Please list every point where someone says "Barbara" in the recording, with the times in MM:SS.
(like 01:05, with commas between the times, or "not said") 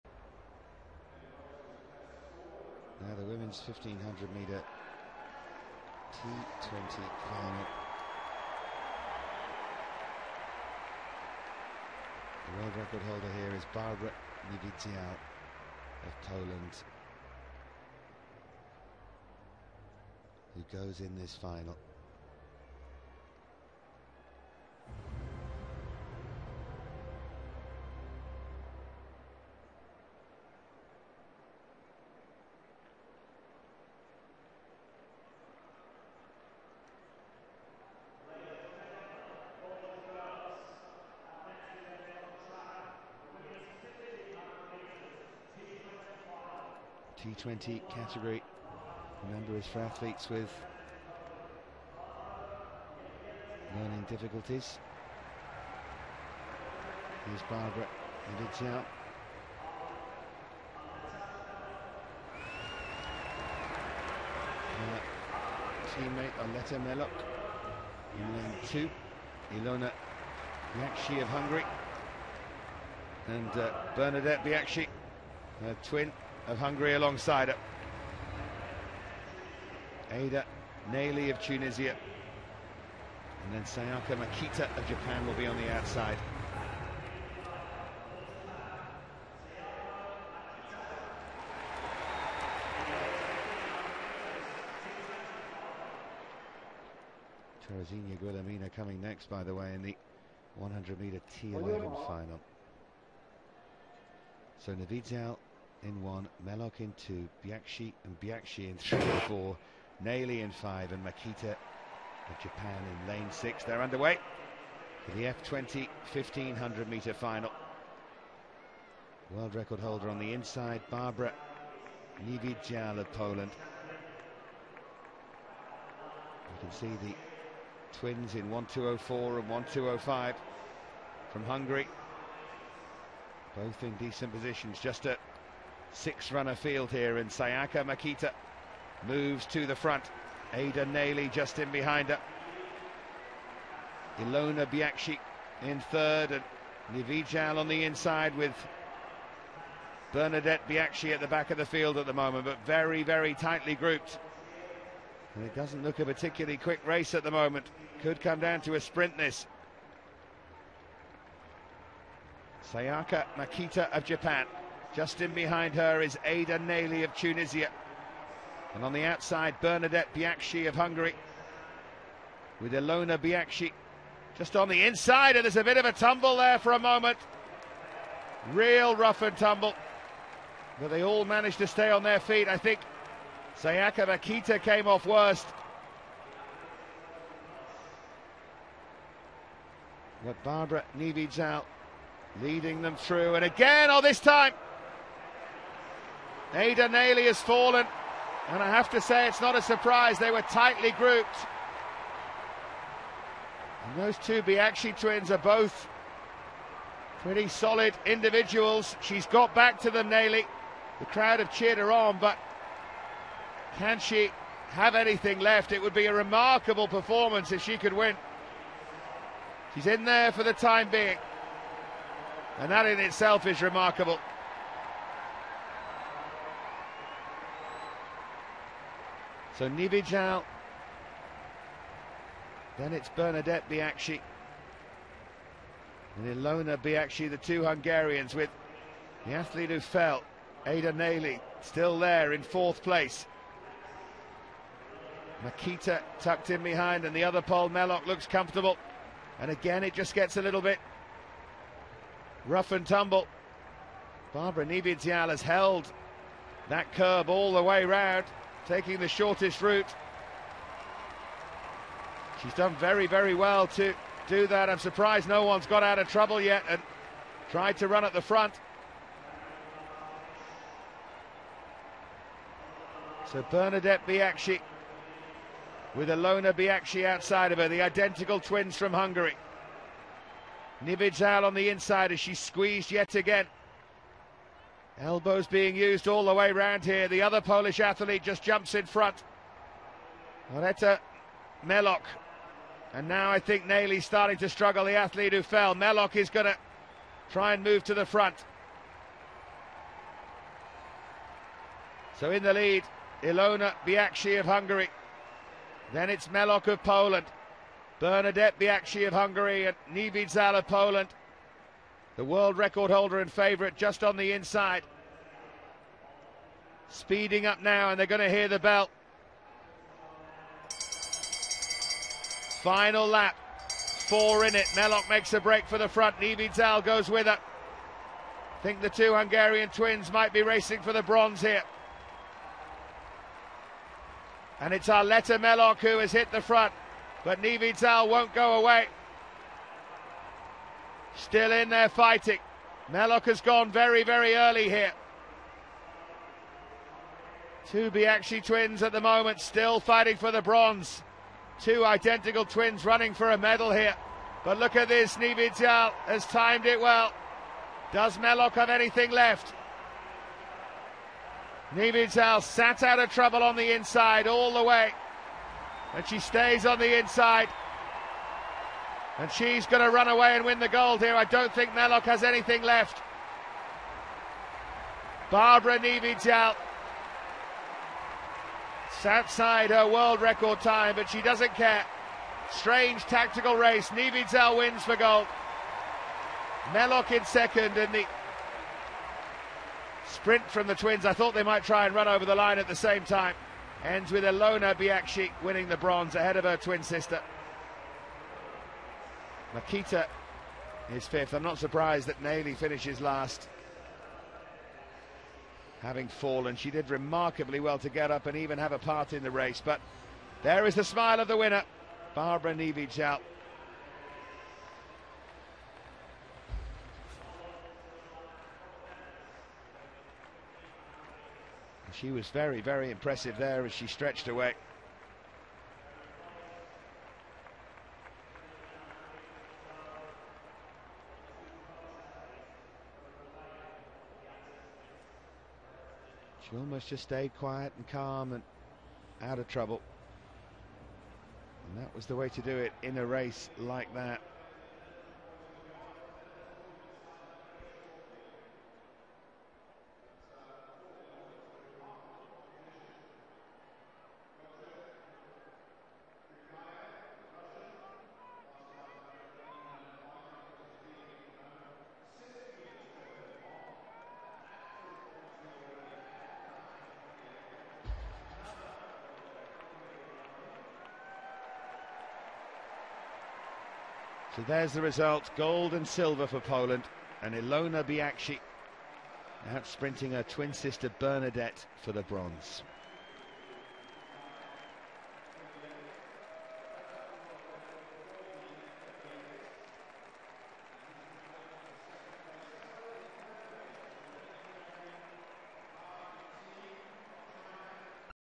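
00:13, 00:57, 02:00, 03:10, 04:14, 06:15, 06:52.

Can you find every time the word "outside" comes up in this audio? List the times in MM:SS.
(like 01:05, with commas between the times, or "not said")
01:25, 02:49, 04:37, 06:19.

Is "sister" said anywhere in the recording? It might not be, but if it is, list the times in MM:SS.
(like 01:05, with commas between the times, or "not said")
06:36, 08:00.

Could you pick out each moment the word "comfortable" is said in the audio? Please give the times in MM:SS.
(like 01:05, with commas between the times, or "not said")
04:08.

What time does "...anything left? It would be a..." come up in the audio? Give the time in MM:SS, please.
03:34.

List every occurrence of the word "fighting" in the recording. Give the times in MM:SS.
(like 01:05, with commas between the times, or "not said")
05:41, 05:49.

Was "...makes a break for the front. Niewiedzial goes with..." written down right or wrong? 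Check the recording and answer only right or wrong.
right.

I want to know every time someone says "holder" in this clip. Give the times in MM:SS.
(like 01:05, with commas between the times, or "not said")
00:13, 01:59, 05:12.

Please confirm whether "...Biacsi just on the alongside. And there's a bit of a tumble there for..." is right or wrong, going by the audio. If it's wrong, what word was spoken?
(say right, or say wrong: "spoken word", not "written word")
wrong: "inside", not "alongside".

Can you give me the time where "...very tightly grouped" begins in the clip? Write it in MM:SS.
02:33.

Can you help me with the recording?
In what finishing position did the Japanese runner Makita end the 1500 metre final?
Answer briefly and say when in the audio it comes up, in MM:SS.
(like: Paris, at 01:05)
fifth, at 06:41.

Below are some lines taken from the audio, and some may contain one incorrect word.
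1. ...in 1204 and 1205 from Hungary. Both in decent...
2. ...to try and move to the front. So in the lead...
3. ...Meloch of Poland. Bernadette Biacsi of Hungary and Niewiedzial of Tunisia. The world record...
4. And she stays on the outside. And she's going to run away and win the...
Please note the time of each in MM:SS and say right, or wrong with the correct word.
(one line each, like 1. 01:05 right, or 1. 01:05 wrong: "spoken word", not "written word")
1. 02:08 right
2. 04:56 right
3. 05:06 wrong: "Poland", not "Tunisia"
4. 06:05 wrong: "inside", not "outside".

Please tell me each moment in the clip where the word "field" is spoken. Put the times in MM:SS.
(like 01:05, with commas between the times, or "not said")
02:16, 02:31.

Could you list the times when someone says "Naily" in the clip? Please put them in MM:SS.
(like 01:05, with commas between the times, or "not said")
01:20, 01:50, 02:46, 03:16, 03:30, 04:53, 06:42.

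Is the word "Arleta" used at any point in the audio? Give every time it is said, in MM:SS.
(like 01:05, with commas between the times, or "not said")
01:06, 04:50, 05:34.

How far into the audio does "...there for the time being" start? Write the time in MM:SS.
03:40.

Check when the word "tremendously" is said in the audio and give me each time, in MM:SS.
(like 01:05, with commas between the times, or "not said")
not said.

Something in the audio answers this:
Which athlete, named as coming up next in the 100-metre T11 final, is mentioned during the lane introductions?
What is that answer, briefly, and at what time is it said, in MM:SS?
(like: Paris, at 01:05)
Terezinha Guilhermina, at 01:37.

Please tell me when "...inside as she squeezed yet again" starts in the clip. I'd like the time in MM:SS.
04:41.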